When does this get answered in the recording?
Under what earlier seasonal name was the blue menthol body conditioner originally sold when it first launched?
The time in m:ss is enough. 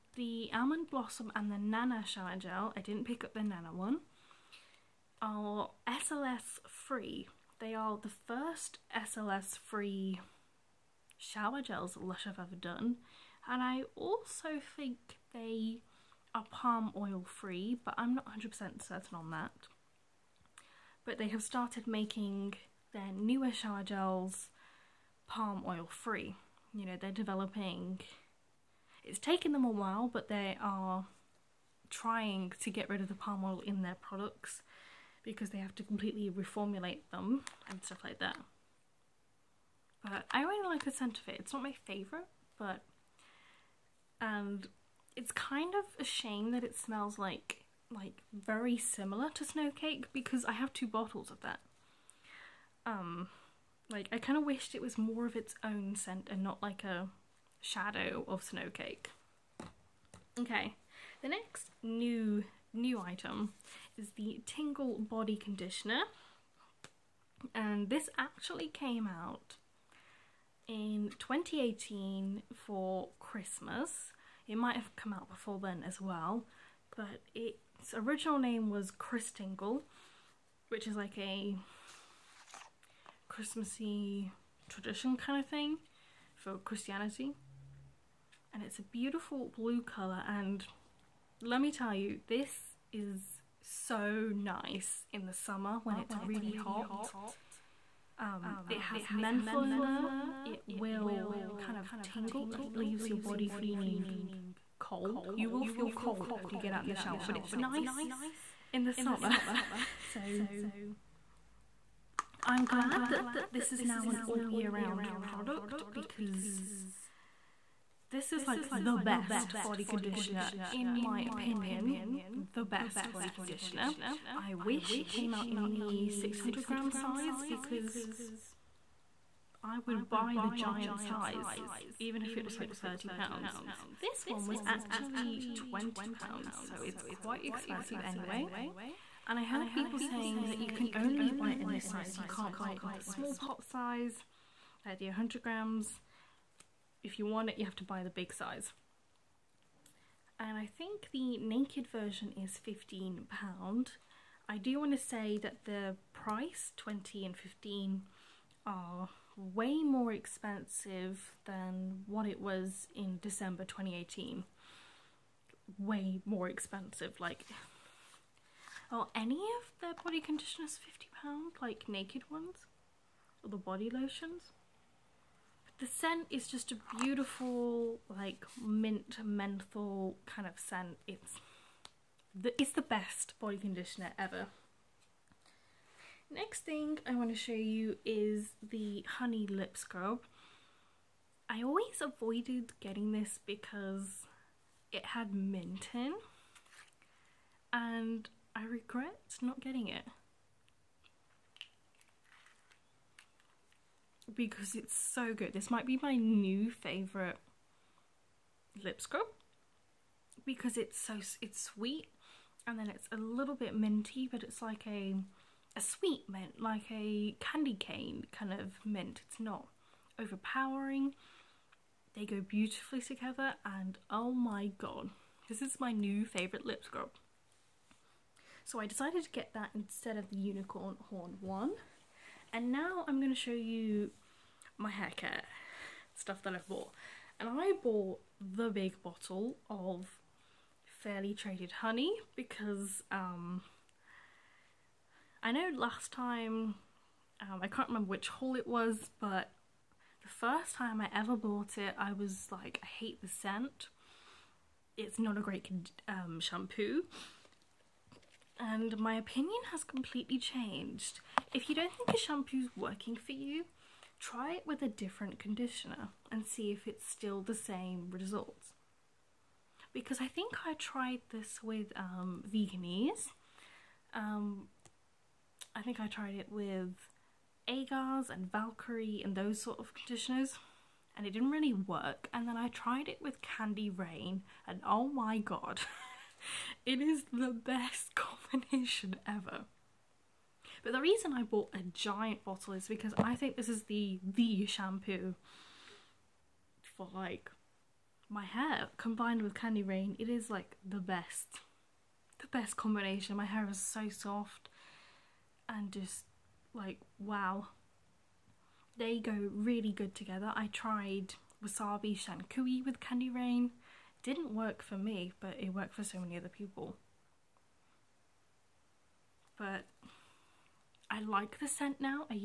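1:18.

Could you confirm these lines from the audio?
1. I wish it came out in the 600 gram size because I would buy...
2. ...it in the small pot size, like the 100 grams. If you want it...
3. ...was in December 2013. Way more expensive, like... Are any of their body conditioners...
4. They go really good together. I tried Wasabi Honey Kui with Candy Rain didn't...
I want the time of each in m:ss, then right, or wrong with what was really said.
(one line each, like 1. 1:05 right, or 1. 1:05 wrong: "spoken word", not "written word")
1. 2:04 right
2. 2:22 right
3. 2:42 wrong: "2018", not "2013"
4. 5:08 wrong: "Shan", not "Honey".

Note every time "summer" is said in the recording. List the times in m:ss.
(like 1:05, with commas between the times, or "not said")
1:35, 1:48.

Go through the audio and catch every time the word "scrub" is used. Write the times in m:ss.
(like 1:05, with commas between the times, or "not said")
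3:09, 3:28, 3:46.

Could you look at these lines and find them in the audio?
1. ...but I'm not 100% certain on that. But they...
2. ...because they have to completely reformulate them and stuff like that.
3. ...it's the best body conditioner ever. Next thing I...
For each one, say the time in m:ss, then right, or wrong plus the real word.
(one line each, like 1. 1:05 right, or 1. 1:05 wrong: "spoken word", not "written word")
1. 0:17 right
2. 0:35 right
3. 3:02 right.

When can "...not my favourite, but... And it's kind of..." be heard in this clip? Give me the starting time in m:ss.
0:41.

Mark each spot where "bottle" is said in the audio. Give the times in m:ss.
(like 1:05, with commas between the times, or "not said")
0:50, 3:59, 4:52.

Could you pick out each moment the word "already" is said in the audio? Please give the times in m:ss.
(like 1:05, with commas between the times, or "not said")
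not said.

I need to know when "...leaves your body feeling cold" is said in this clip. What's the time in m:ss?
1:42.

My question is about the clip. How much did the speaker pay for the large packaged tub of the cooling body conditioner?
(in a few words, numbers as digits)
£20.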